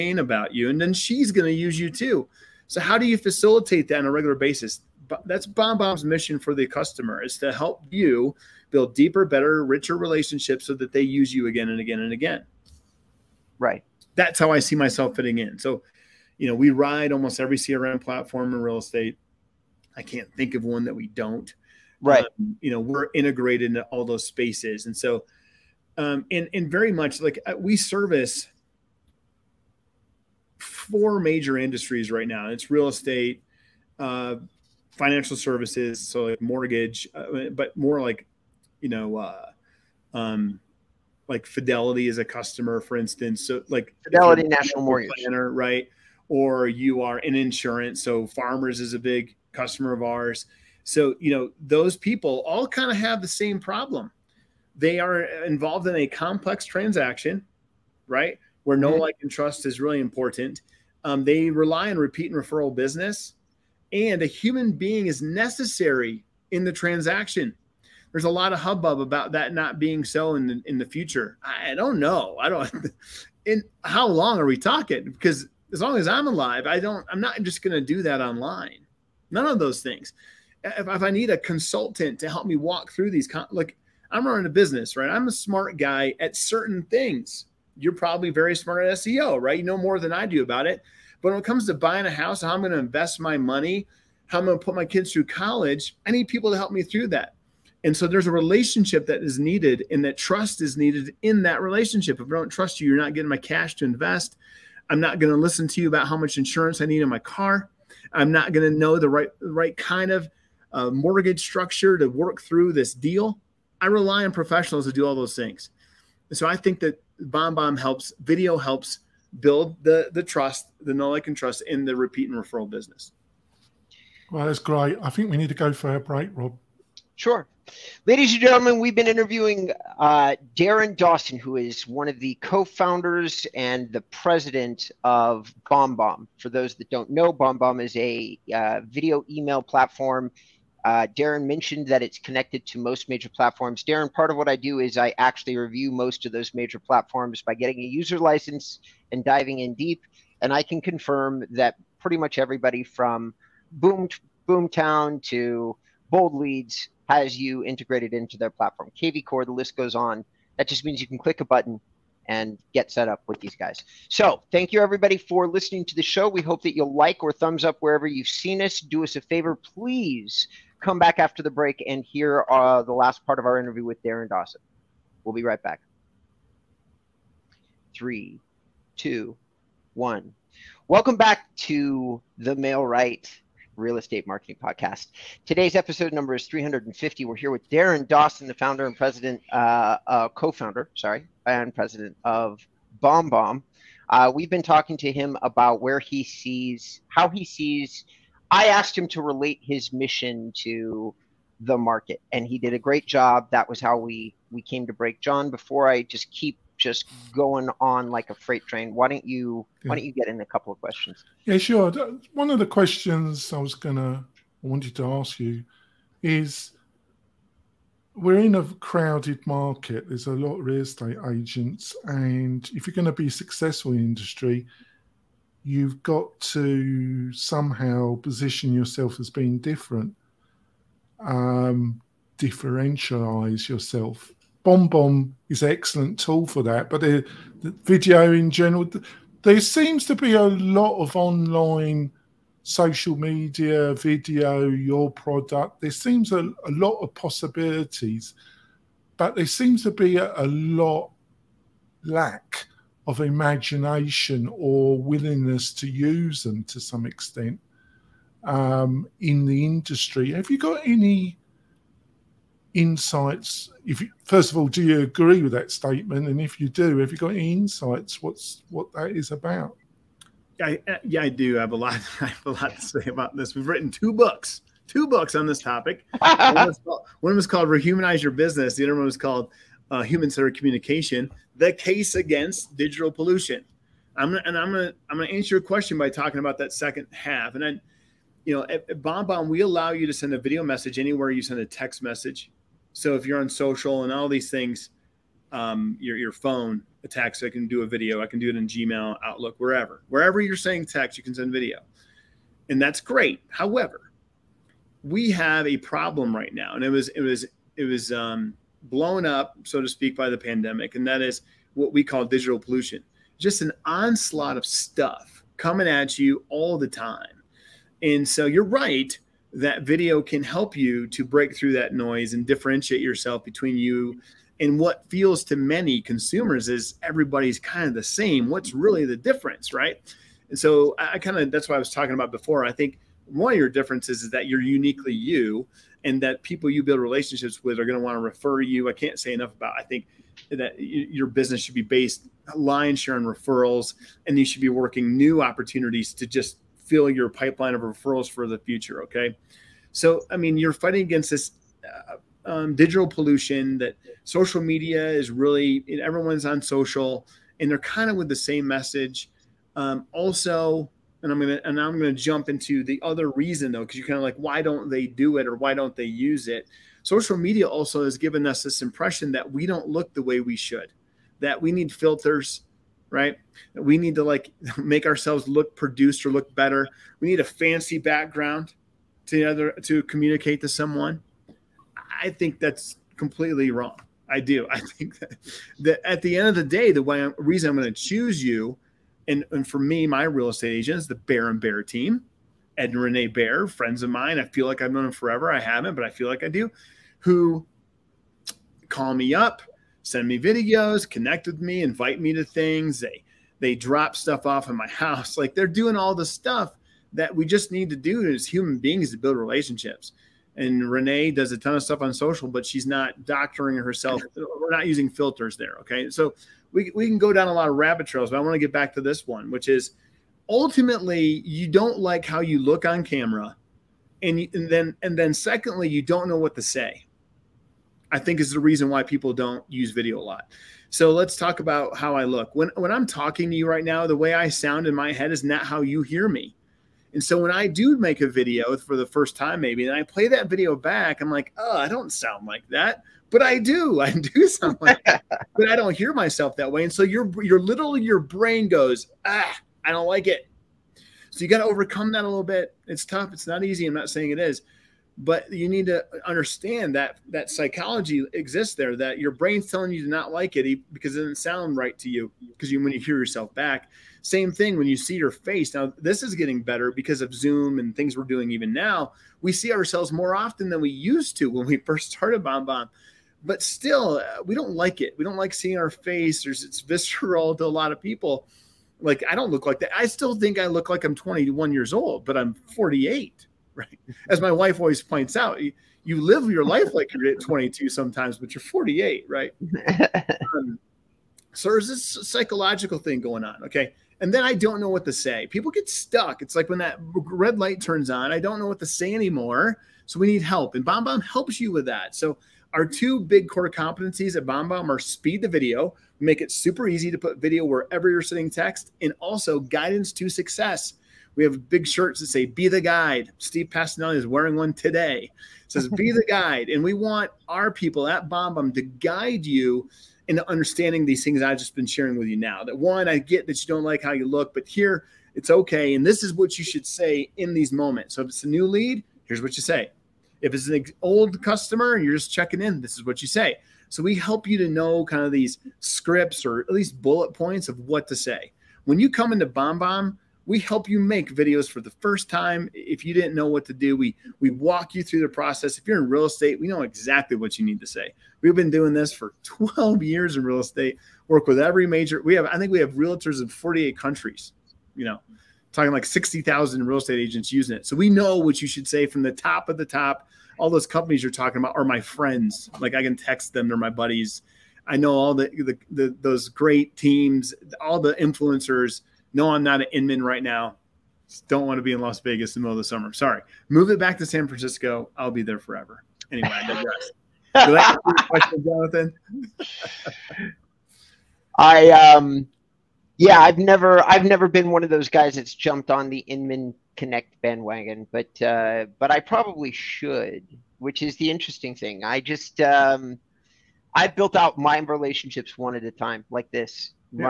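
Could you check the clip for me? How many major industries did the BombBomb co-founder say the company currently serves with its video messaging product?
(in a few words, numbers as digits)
4.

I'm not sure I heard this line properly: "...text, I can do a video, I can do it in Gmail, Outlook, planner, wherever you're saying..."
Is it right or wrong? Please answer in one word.
wrong.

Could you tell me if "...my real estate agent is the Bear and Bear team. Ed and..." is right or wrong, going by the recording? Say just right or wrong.
right.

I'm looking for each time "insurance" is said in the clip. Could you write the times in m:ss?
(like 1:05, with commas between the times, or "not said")
0:47, 1:46.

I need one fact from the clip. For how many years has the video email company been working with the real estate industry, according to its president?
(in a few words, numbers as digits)
12 years.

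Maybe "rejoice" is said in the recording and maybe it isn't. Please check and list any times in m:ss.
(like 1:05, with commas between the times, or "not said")
not said.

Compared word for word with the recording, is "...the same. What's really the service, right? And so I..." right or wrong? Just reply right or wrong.
wrong.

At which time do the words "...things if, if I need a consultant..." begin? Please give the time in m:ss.
1:19.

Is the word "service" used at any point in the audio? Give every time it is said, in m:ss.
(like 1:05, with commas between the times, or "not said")
0:27, 0:35.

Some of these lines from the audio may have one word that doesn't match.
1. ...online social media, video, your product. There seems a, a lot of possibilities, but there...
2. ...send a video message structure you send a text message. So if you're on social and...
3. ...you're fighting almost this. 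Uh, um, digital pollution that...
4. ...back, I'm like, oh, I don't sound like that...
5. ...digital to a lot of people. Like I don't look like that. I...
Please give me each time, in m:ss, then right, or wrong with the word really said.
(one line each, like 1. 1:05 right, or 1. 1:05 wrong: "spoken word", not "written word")
1. 4:01 right
2. 4:50 wrong: "anywhere", not "structure"
3. 5:50 wrong: "against", not "almost"
4. 7:20 right
5. 7:56 wrong: "visceral", not "digital".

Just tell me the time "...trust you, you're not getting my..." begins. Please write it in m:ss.
1:42.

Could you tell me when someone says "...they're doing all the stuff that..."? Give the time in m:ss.
6:45.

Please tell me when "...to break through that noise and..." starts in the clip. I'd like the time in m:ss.
5:21.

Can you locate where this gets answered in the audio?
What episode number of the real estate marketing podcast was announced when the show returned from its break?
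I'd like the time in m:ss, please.
3:06.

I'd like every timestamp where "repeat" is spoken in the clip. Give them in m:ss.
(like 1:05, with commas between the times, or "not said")
1:01, 2:01.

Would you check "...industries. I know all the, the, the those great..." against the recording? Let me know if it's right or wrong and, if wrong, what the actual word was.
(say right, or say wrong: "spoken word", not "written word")
wrong: "buddies", not "industries".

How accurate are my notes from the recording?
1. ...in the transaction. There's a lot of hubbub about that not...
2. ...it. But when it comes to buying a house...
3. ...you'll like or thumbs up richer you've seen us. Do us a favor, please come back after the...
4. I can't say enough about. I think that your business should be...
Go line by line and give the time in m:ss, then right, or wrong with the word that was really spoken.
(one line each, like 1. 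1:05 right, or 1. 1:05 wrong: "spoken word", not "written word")
1. 1:06 right
2. 1:30 right
3. 2:46 wrong: "wherever", not "richer"
4. 5:38 right.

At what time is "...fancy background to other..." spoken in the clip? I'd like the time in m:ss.
6:17.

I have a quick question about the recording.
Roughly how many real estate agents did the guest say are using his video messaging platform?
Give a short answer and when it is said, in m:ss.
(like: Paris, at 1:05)
60,000, at 9:16.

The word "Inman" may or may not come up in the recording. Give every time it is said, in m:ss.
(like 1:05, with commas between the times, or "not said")
9:29, 9:46.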